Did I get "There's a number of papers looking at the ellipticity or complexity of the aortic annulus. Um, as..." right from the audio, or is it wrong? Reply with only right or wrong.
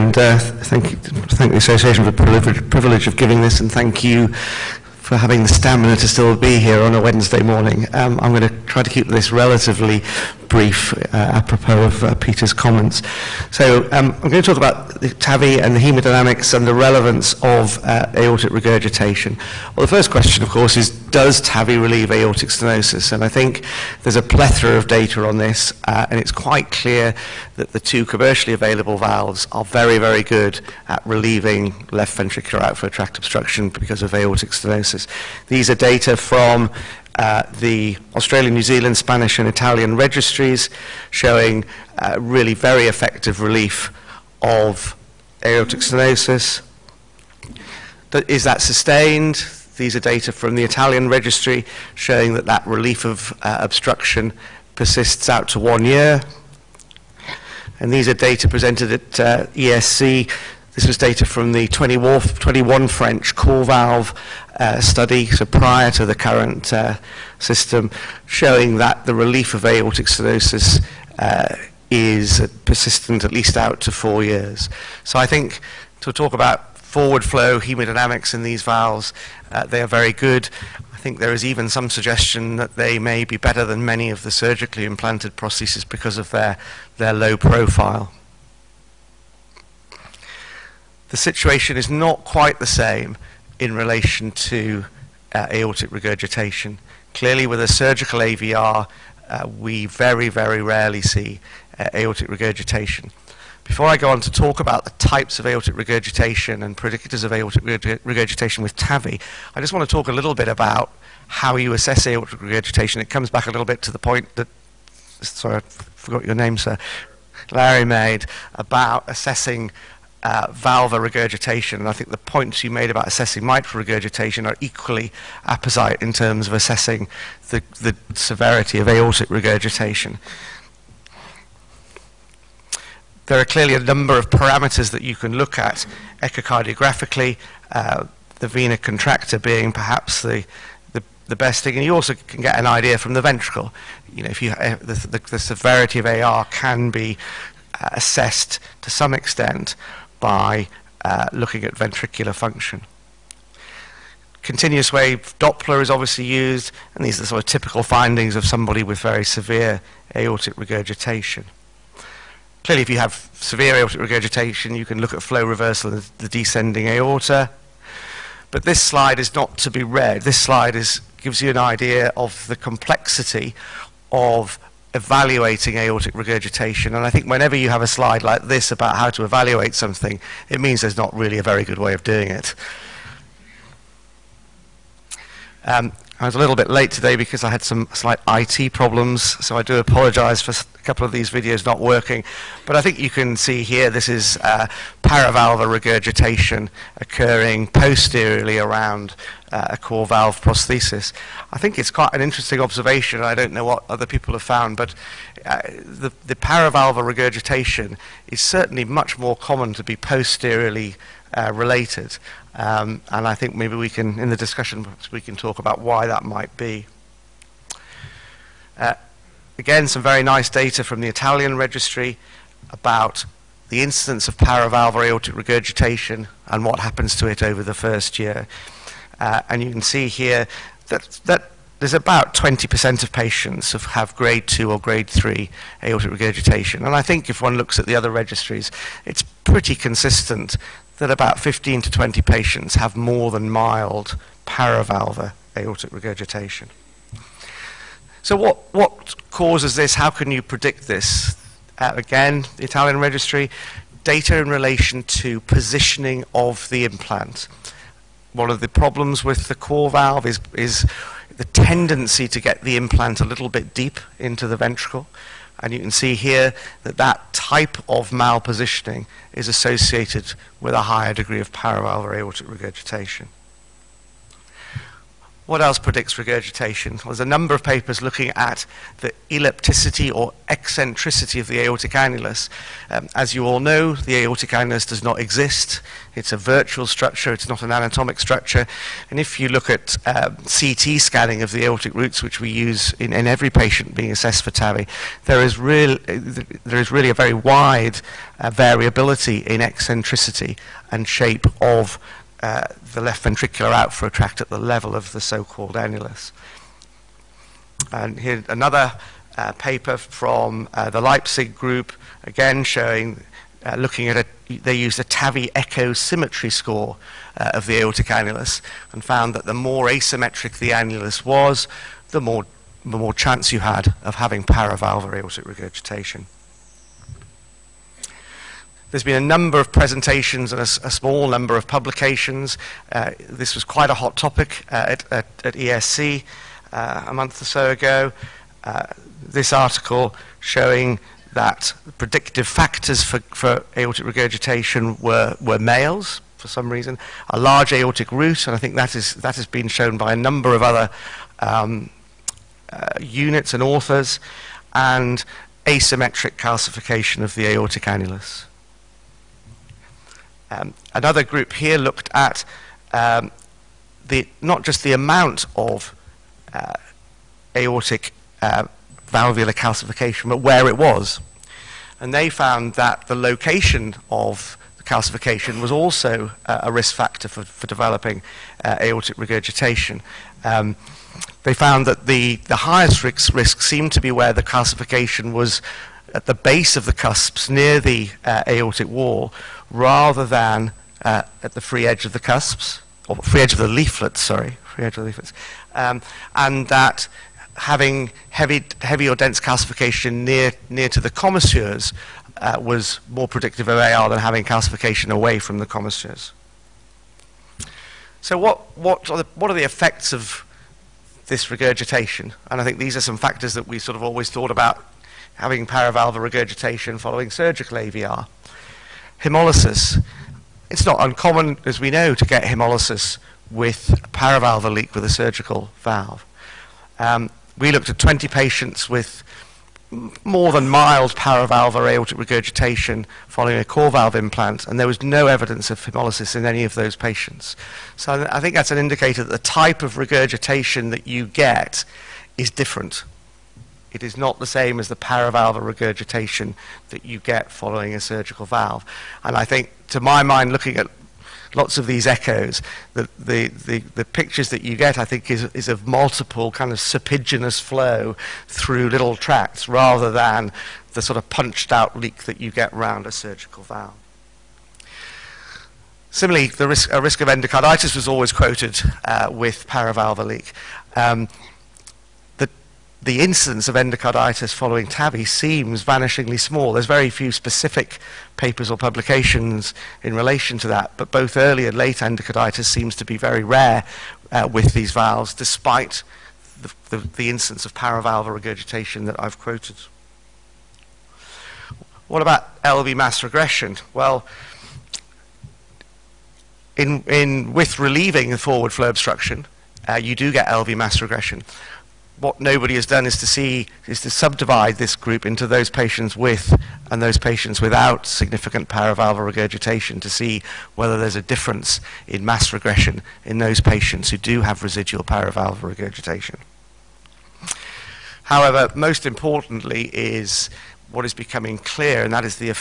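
wrong.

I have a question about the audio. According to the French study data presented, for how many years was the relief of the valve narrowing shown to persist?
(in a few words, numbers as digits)
4.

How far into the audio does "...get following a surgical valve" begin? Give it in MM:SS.
07:27.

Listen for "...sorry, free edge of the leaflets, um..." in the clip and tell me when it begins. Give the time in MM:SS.
06:34.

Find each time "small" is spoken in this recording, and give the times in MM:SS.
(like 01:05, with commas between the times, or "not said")
05:30, 07:56.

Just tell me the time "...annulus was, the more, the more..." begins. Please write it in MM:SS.
05:20.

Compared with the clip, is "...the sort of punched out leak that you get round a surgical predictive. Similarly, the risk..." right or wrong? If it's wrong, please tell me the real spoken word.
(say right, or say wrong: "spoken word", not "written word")
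wrong: "valve", not "predictive".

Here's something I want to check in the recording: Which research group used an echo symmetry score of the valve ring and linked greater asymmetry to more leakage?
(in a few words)
Leipzig.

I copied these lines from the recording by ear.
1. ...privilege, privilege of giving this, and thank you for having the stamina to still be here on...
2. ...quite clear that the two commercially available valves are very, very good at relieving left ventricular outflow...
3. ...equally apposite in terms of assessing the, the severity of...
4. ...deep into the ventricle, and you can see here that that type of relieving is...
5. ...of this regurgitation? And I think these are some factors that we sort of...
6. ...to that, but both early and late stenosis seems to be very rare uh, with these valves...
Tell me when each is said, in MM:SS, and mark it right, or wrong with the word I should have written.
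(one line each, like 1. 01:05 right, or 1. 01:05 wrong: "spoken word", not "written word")
1. 00:02 right
2. 00:26 right
3. 02:04 right
4. 04:23 wrong: "malpositioning", not "relieving"
5. 06:50 right
6. 08:00 wrong: "endocarditis", not "stenosis".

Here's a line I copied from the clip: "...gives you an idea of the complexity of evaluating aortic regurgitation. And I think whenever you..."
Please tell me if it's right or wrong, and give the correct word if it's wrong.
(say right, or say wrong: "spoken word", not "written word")
right.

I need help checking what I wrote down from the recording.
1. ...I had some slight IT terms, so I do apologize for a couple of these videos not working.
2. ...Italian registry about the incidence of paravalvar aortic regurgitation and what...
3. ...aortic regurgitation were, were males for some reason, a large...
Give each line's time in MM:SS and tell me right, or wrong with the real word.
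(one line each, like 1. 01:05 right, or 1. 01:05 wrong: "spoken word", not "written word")
1. 03:07 wrong: "problems", not "terms"
2. 03:41 right
3. 05:43 right.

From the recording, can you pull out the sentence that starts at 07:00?
It's not uncommon, as we know, to get hemolysis with paravalvular leak with a surgical valve.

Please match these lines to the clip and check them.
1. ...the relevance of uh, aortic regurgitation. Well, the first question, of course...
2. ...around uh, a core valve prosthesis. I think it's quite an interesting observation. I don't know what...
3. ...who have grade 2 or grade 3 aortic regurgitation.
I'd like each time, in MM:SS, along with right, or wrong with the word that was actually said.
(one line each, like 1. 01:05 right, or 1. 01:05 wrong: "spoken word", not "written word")
1. 00:16 right
2. 03:18 right
3. 03:53 right.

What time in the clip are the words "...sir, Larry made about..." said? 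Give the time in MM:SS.
01:56.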